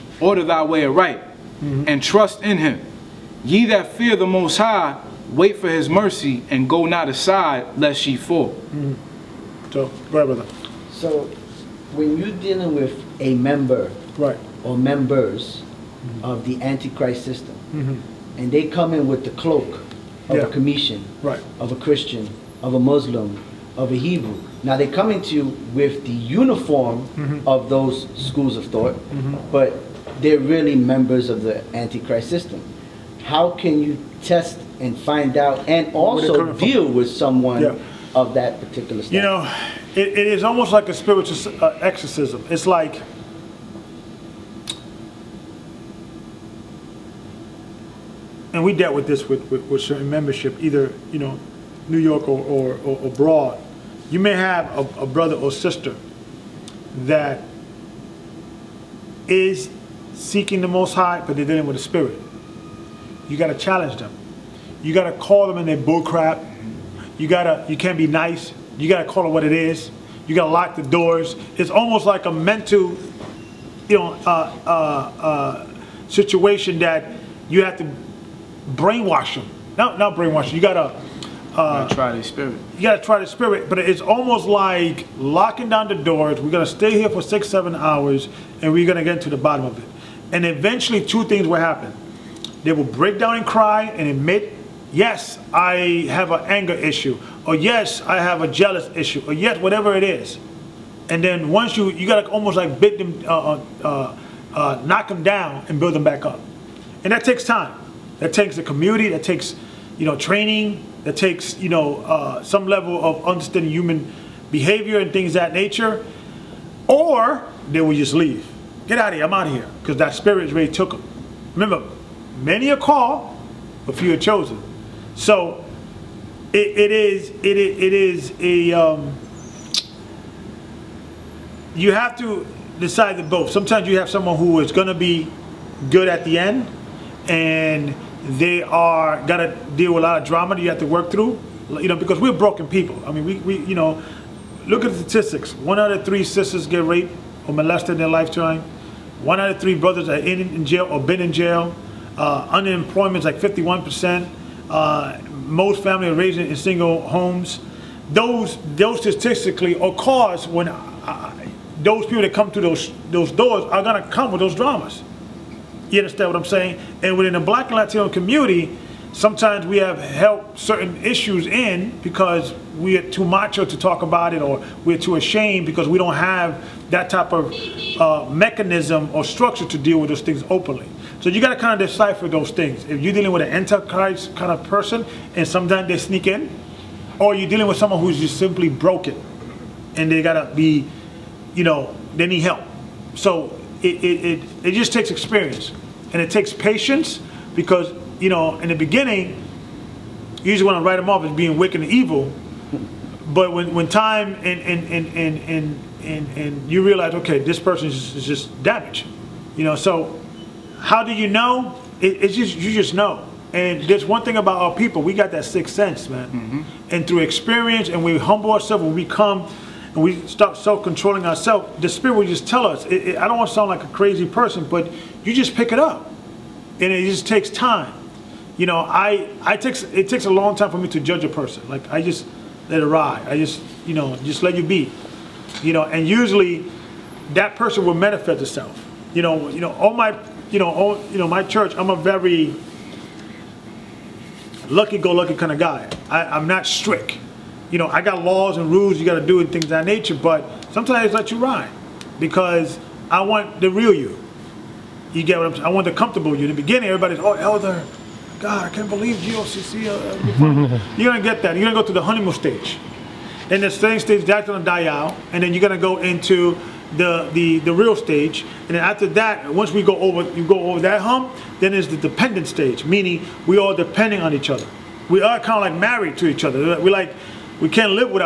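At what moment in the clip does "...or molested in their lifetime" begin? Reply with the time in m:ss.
2:27.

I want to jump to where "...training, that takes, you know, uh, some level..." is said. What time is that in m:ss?
1:50.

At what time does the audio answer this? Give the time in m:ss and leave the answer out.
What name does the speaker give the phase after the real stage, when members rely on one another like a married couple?
4:31.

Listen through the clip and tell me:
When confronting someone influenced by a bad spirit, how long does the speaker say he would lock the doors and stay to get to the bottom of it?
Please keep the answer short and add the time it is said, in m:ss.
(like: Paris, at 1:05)
6 or 7 hours, at 1:27.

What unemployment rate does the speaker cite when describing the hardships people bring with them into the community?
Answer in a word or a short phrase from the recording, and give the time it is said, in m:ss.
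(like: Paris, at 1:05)
51%, at 2:33.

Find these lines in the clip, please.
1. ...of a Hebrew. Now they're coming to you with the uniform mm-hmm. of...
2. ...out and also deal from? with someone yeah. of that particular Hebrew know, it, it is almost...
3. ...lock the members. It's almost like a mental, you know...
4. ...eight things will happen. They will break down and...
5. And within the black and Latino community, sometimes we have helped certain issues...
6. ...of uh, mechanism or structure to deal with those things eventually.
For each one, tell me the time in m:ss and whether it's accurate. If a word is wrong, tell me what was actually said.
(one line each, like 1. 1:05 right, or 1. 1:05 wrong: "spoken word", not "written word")
1. 0:23 right
2. 0:35 wrong: "You", not "Hebrew"
3. 1:10 wrong: "doors", not "members"
4. 1:31 wrong: "two", not "eight"
5. 2:47 right
6. 2:57 wrong: "openly", not "eventually".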